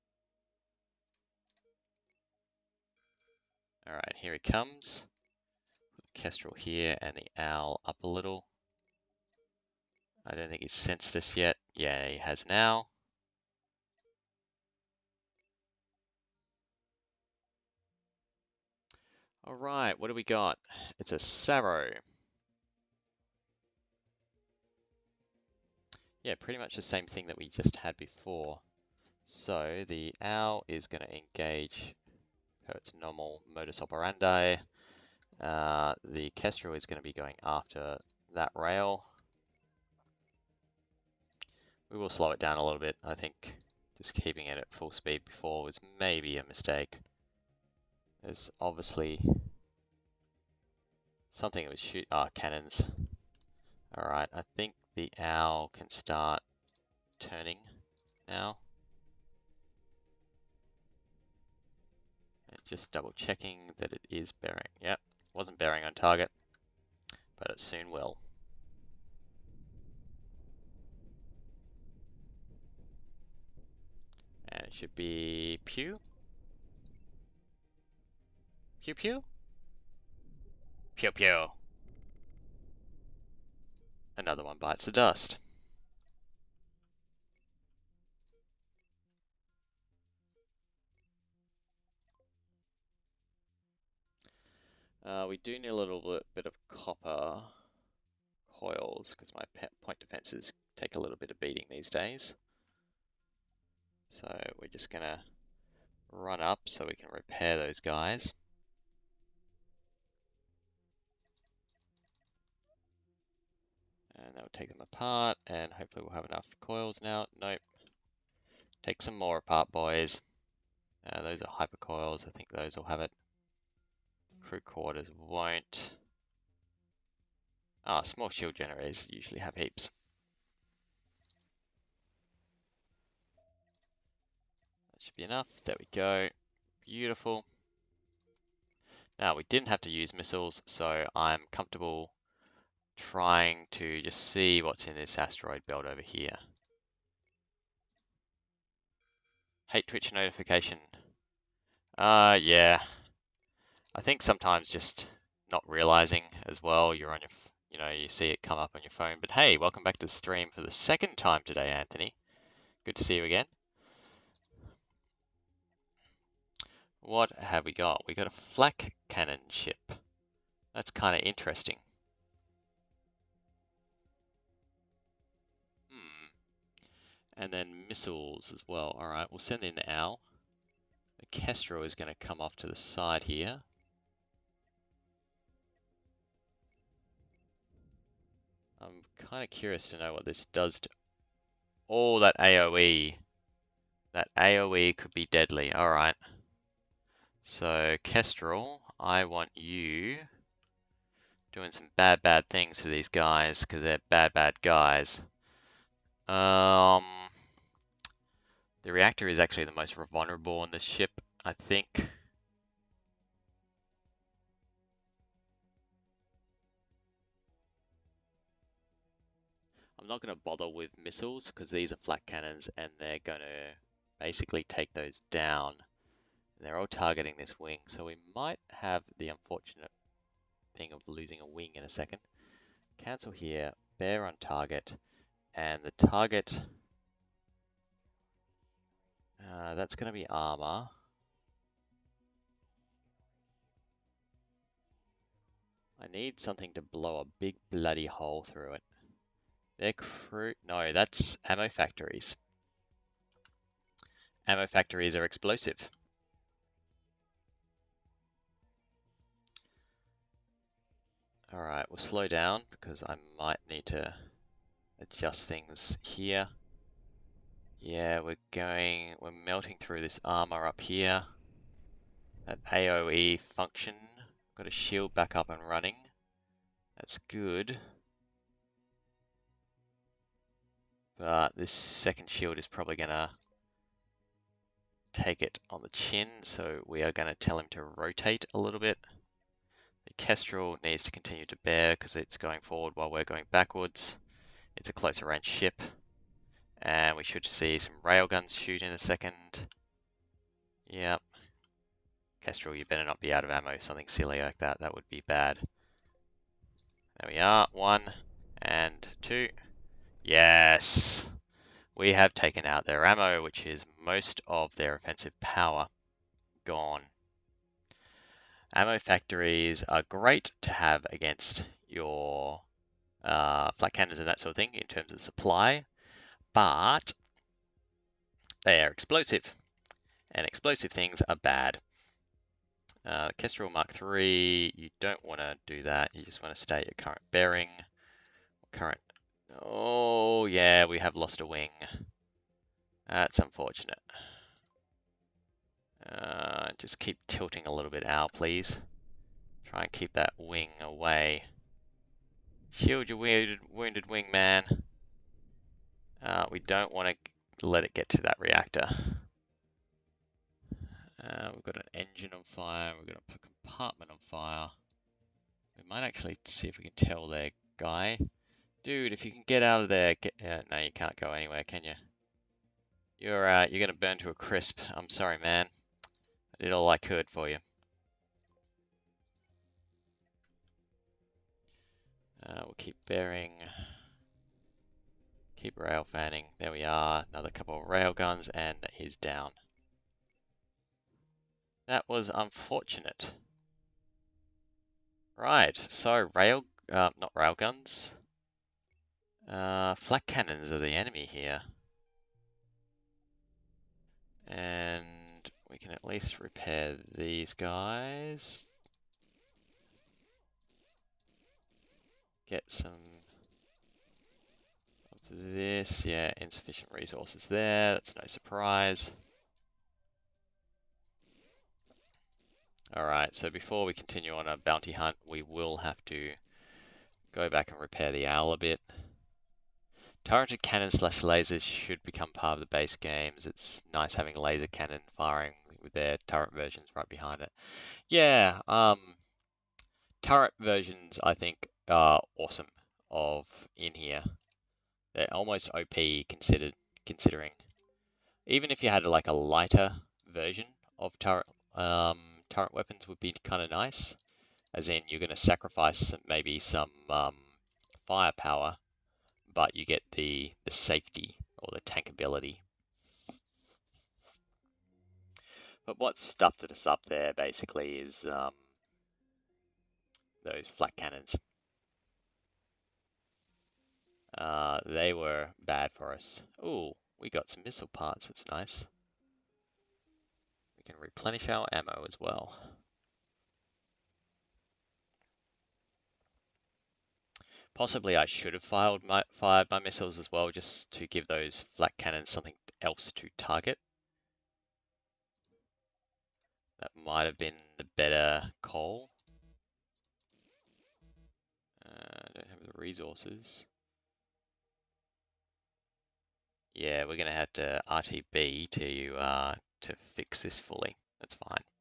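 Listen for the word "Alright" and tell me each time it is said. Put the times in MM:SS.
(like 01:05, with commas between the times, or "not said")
00:03, 07:02.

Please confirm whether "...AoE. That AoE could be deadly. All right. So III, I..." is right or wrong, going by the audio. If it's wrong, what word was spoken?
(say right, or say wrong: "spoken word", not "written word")
wrong: "Kestrel", not "III".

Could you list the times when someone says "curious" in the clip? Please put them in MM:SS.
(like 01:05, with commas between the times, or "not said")
03:09.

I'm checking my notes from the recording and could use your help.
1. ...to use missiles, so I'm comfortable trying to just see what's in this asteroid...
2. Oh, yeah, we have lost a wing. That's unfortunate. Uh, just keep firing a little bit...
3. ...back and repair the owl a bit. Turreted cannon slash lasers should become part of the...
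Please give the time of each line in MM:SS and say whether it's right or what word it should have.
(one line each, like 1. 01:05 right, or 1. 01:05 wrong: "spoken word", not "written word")
1. 02:19 right
2. 05:39 wrong: "tilting", not "firing"
3. 07:07 right.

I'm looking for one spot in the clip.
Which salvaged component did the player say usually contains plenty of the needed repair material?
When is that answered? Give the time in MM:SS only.
02:08.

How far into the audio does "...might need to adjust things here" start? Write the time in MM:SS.
04:23.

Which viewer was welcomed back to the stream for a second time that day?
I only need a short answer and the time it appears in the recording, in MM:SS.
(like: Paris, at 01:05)
Anthony, at 02:41.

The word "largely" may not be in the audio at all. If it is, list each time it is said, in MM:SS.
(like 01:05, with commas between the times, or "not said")
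not said.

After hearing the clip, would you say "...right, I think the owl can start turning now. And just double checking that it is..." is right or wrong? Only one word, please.
right.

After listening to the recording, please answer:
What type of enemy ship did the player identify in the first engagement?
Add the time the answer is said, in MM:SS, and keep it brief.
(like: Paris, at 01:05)
Sarrow, at 00:21.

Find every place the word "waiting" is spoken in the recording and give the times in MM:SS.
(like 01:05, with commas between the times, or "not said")
not said.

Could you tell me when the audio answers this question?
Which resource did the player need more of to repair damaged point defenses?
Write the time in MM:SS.
01:36.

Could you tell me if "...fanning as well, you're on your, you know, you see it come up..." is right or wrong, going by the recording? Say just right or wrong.
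wrong.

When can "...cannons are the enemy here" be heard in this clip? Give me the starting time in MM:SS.
06:40.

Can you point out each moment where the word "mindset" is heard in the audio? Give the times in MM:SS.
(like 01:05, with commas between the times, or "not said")
not said.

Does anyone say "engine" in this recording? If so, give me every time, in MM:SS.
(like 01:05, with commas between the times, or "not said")
06:01.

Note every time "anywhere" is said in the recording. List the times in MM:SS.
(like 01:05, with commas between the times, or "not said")
06:11.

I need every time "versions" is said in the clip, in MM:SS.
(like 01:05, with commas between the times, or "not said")
07:16, 07:20, 07:30.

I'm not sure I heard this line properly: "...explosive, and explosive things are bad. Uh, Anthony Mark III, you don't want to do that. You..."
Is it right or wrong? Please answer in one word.
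wrong.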